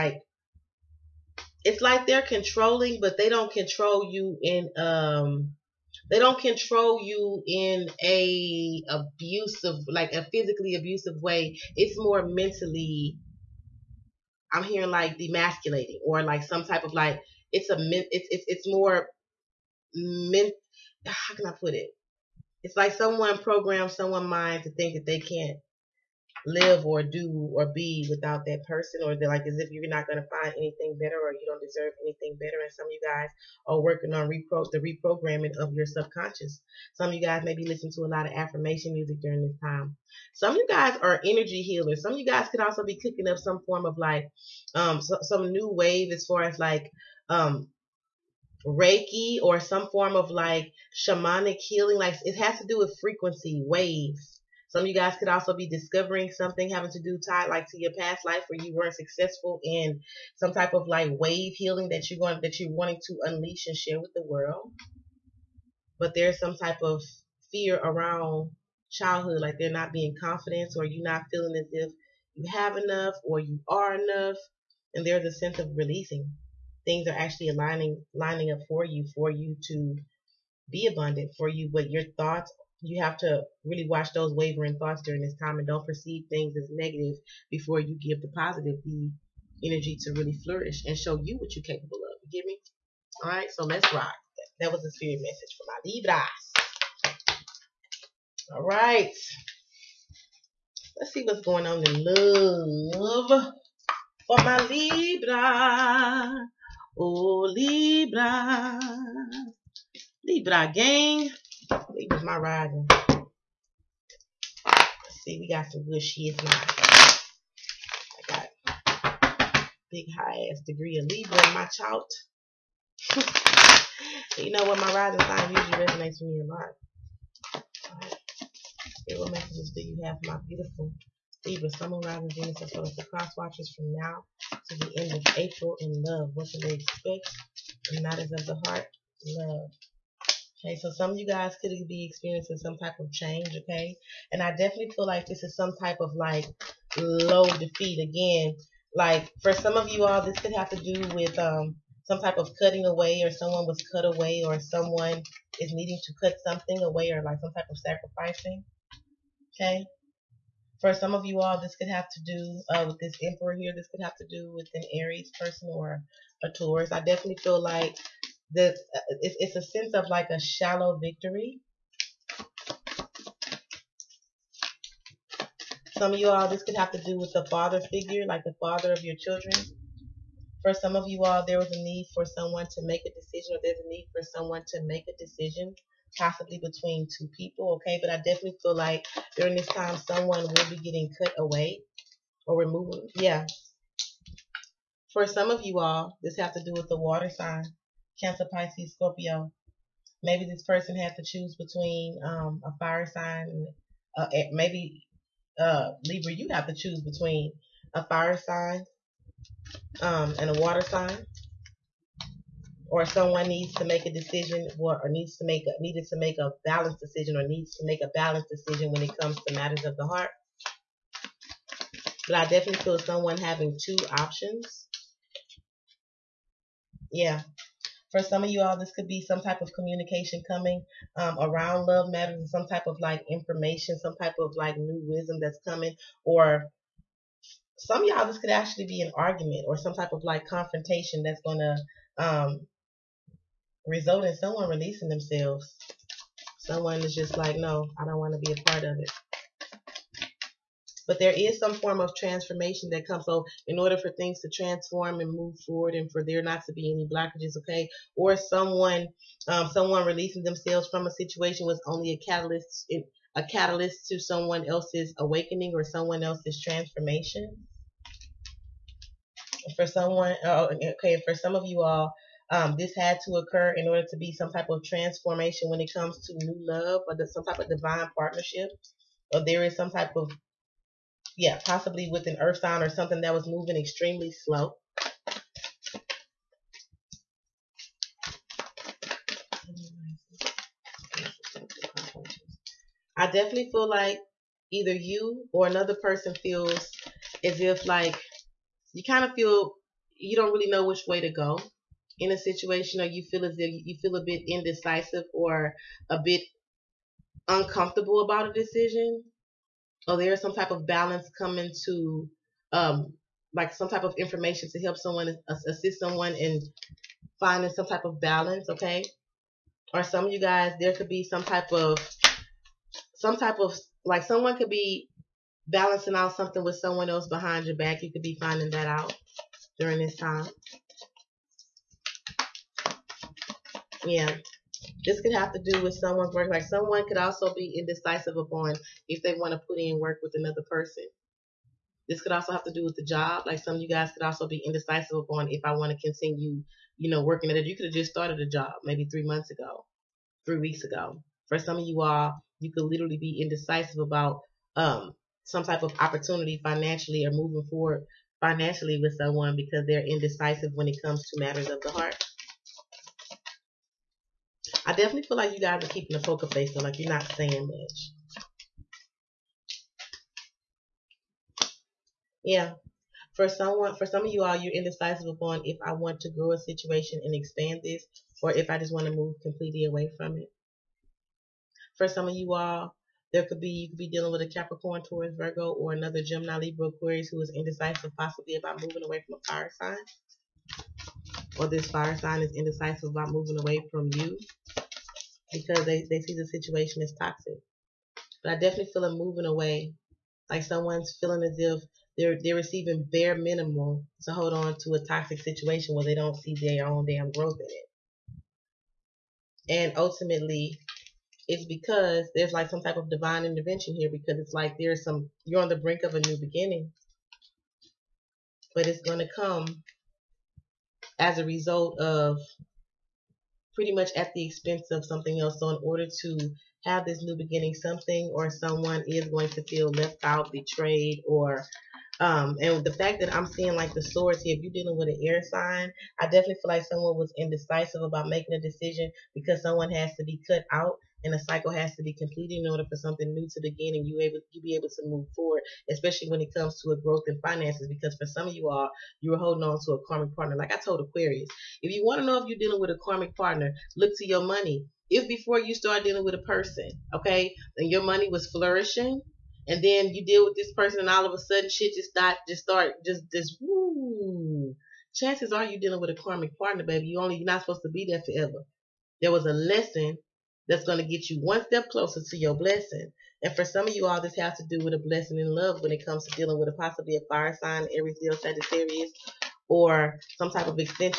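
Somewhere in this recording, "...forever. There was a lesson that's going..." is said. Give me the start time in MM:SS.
07:48.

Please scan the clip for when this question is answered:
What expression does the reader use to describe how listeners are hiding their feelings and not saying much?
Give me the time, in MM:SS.
06:06.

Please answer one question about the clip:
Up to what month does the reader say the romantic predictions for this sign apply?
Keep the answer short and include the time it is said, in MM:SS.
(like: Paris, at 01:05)
April, at 02:15.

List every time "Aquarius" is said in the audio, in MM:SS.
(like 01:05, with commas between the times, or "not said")
06:26, 07:31.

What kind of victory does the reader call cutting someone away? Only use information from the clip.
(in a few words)
Shallow victory.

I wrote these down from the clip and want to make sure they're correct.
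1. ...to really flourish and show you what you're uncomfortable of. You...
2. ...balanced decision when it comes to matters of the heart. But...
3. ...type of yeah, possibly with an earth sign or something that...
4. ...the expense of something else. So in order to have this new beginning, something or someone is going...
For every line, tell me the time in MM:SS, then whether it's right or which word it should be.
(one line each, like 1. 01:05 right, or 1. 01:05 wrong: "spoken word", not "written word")
1. 01:29 wrong: "capable", not "uncomfortable"
2. 03:38 right
3. 04:39 right
4. 07:04 right.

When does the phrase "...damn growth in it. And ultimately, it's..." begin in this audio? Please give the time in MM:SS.
06:47.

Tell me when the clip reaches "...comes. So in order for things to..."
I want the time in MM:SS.
04:13.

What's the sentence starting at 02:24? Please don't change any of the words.
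And I definitely feel like this is some type of like low defeat.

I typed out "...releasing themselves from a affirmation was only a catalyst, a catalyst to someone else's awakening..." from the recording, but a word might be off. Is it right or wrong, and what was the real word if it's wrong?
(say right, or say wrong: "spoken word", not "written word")
wrong: "situation", not "affirmation".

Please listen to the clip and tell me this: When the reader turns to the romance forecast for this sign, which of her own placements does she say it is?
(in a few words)
Rising sign.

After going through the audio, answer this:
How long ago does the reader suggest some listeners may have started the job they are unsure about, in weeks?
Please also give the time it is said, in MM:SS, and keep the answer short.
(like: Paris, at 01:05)
3 weeks, at 05:50.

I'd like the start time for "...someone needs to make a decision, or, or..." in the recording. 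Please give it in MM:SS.
03:33.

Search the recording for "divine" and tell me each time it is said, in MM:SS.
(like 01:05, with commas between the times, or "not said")
04:37, 06:53.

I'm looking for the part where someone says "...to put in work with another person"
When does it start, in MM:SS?
05:39.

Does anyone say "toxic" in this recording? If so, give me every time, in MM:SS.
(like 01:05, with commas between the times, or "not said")
06:37, 06:45.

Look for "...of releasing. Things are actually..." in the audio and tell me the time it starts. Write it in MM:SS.
01:15.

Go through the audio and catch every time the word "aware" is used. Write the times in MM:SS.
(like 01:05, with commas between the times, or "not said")
not said.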